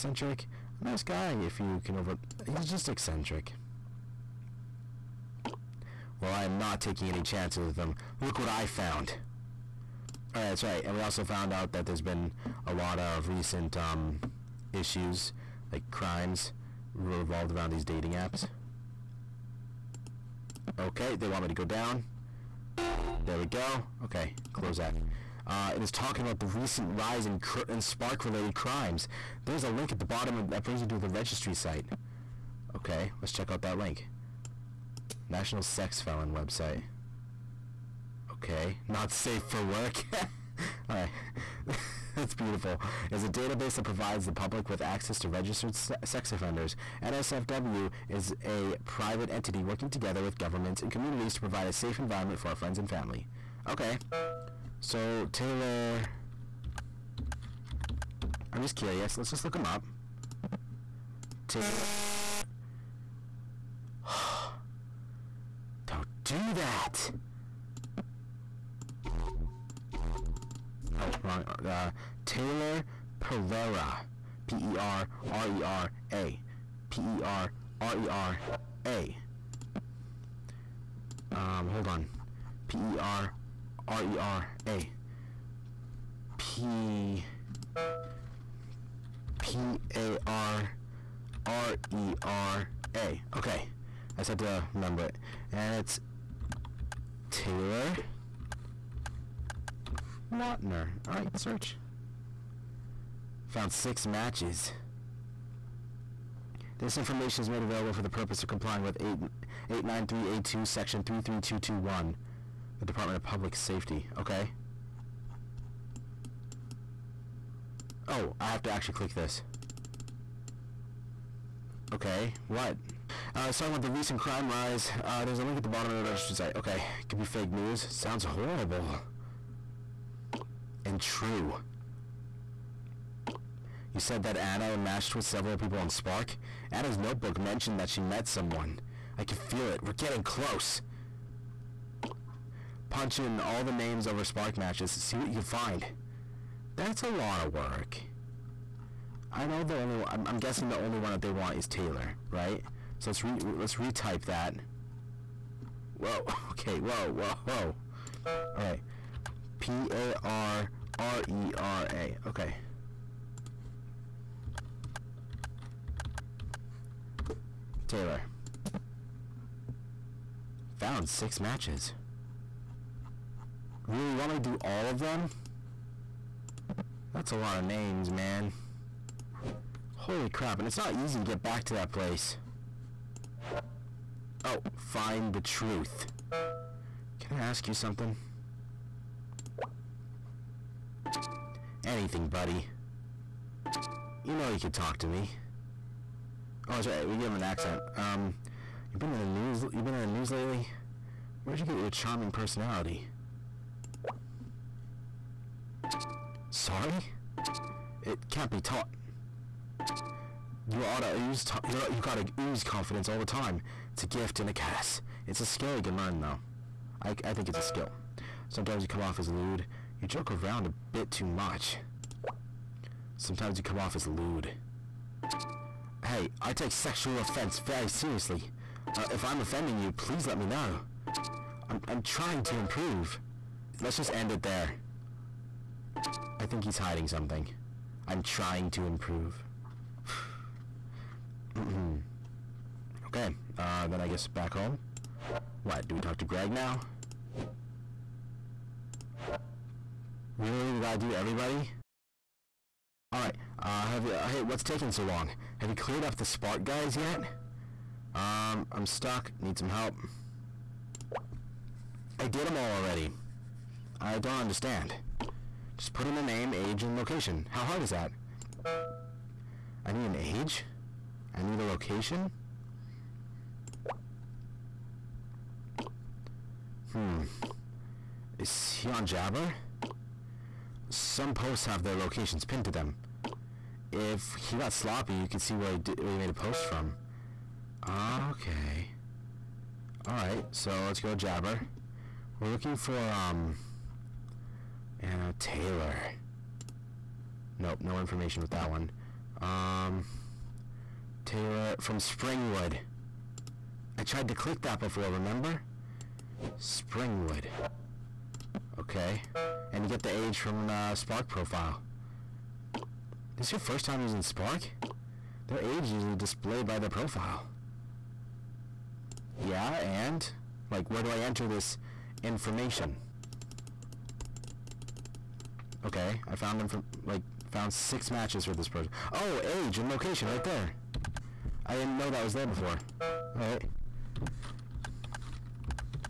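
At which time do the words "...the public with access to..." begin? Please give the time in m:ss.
0:44.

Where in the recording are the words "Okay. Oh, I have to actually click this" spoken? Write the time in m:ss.
1:54.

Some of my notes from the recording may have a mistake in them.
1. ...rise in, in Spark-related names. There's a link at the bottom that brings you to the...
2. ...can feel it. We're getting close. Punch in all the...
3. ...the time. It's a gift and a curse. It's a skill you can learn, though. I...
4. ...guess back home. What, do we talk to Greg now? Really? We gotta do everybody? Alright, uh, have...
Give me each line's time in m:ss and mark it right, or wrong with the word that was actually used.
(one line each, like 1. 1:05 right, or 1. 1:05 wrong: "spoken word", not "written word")
1. 0:26 wrong: "crimes", not "names"
2. 2:19 right
3. 3:33 right
4. 4:04 right.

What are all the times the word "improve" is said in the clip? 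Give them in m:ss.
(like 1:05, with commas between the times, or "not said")
3:52, 3:58.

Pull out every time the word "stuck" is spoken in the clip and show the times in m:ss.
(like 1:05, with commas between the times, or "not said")
4:18.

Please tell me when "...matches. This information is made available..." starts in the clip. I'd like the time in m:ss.
1:44.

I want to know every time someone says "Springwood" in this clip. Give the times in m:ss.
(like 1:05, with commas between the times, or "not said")
5:01, 5:06.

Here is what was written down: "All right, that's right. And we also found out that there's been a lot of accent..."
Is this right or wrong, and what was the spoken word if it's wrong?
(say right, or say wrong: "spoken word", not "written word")
wrong: "recent", not "accent".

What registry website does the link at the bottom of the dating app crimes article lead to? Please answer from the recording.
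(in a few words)
National Sex Felon website.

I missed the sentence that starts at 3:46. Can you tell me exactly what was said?
Hey, I take sexual offense very seriously.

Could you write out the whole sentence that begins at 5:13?
This is your first time using Spark?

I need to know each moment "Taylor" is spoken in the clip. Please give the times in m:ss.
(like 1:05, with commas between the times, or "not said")
0:55, 1:01, 1:12, 1:37, 2:31, 2:47, 4:55, 5:01.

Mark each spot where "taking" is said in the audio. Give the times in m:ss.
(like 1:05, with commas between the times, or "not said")
0:06, 4:14.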